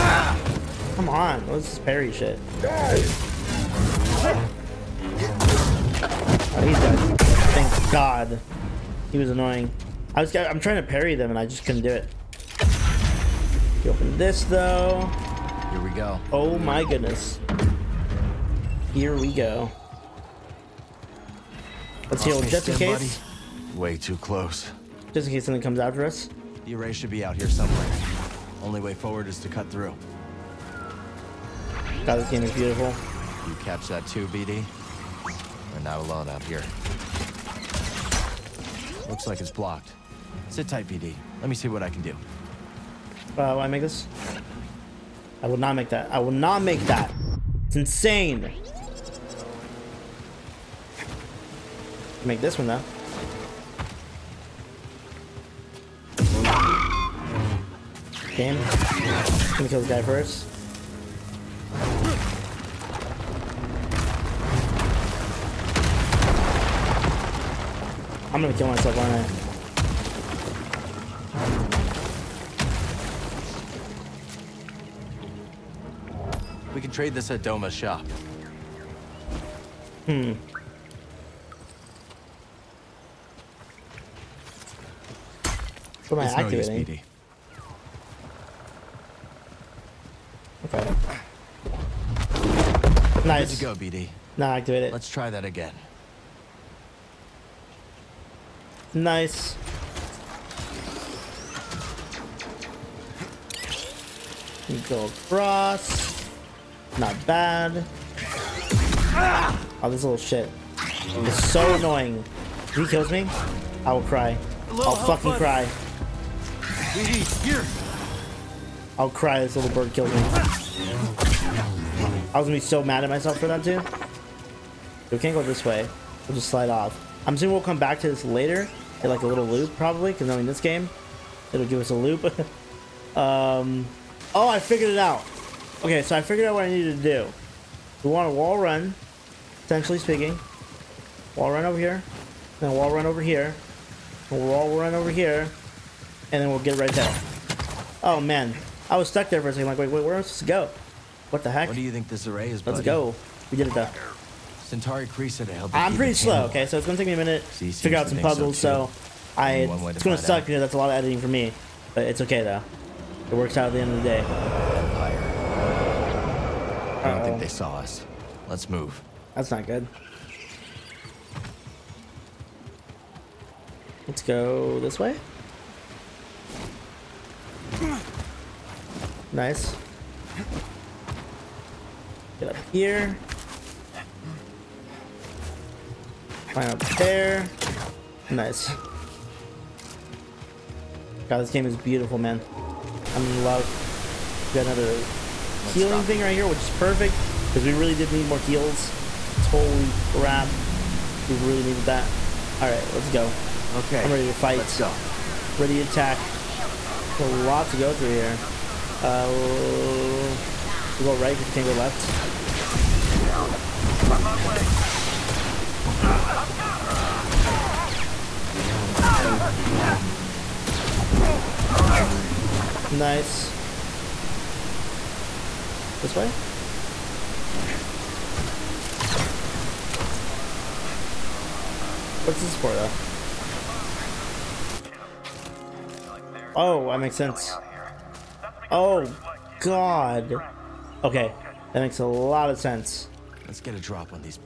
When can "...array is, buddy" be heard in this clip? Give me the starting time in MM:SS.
02:32.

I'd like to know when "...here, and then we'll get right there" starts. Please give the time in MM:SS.
02:25.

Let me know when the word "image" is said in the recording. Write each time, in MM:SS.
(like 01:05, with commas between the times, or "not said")
not said.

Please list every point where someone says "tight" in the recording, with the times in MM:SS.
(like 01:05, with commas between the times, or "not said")
00:40.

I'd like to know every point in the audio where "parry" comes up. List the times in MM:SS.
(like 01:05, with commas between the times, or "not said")
00:01, 00:10.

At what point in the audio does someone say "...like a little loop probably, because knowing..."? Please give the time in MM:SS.
02:09.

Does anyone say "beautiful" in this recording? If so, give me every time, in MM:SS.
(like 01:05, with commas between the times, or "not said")
00:32, 03:11.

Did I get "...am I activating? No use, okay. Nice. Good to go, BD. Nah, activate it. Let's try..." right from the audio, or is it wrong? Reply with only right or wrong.
right.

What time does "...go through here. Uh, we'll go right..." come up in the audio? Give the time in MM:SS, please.
03:27.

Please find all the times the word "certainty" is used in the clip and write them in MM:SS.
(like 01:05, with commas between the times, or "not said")
not said.